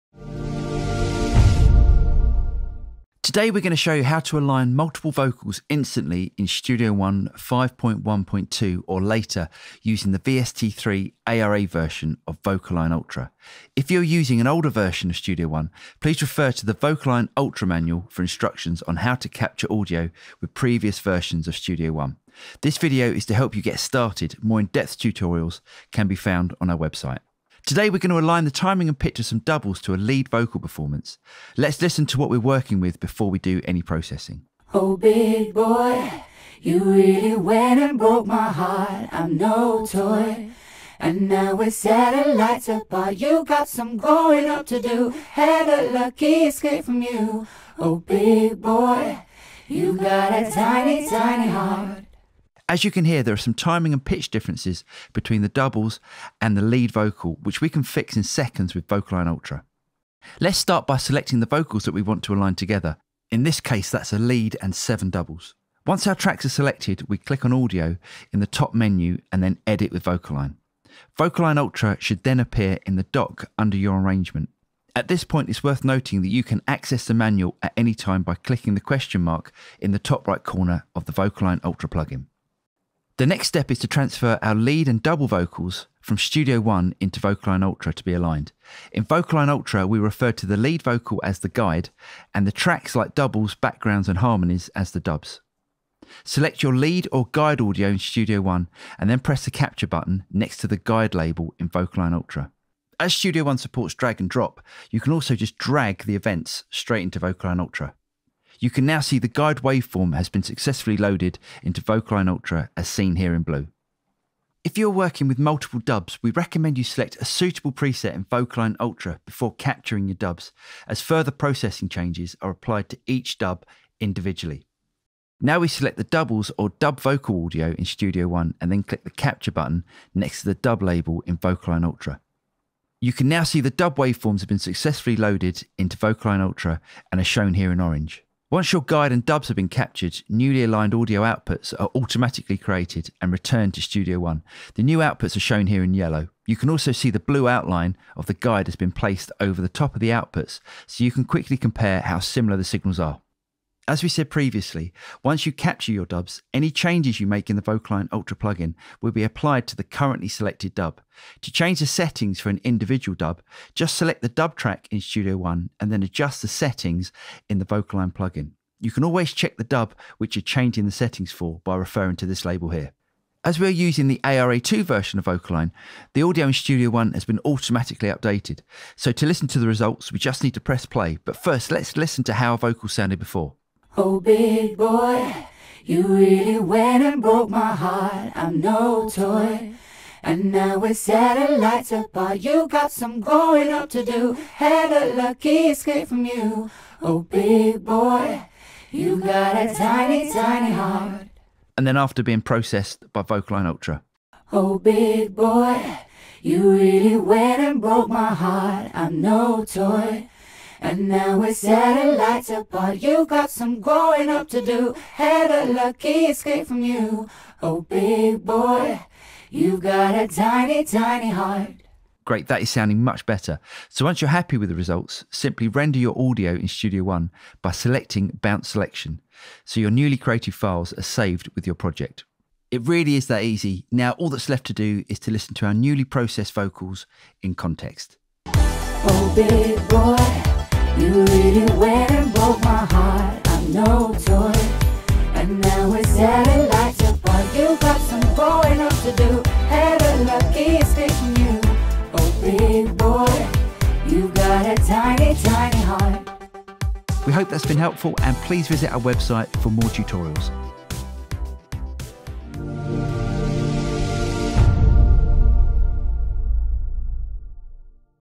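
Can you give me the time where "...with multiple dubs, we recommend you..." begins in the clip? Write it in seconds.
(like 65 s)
115 s.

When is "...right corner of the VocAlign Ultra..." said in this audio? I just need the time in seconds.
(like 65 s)
80 s.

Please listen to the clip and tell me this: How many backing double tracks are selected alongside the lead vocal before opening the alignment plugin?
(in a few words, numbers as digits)
7.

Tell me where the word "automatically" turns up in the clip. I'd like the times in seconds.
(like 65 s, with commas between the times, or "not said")
141 s, 177 s.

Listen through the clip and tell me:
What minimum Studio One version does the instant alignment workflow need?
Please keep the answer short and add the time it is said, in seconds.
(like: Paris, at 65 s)
5.1.2, at 7 s.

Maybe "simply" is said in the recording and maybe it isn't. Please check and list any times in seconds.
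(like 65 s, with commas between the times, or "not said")
225 s.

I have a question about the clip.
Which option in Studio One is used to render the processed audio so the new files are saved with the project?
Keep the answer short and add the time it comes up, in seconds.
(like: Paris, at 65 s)
Bounce Selection, at 228 s.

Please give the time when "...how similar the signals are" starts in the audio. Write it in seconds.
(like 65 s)
152 s.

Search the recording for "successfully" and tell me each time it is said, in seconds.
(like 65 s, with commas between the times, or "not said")
110 s, 134 s.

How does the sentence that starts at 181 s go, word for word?
But first, let's listen to how a vocal sounded before.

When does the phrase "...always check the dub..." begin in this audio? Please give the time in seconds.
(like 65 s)
169 s.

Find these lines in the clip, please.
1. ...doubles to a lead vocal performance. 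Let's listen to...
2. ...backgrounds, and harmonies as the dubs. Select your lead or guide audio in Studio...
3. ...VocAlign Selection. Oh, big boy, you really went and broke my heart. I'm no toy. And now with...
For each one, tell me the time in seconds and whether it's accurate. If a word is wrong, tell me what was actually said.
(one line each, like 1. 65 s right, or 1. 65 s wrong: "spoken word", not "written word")
1. 29 s right
2. 93 s right
3. 203 s wrong: "Ultra", not "Selection".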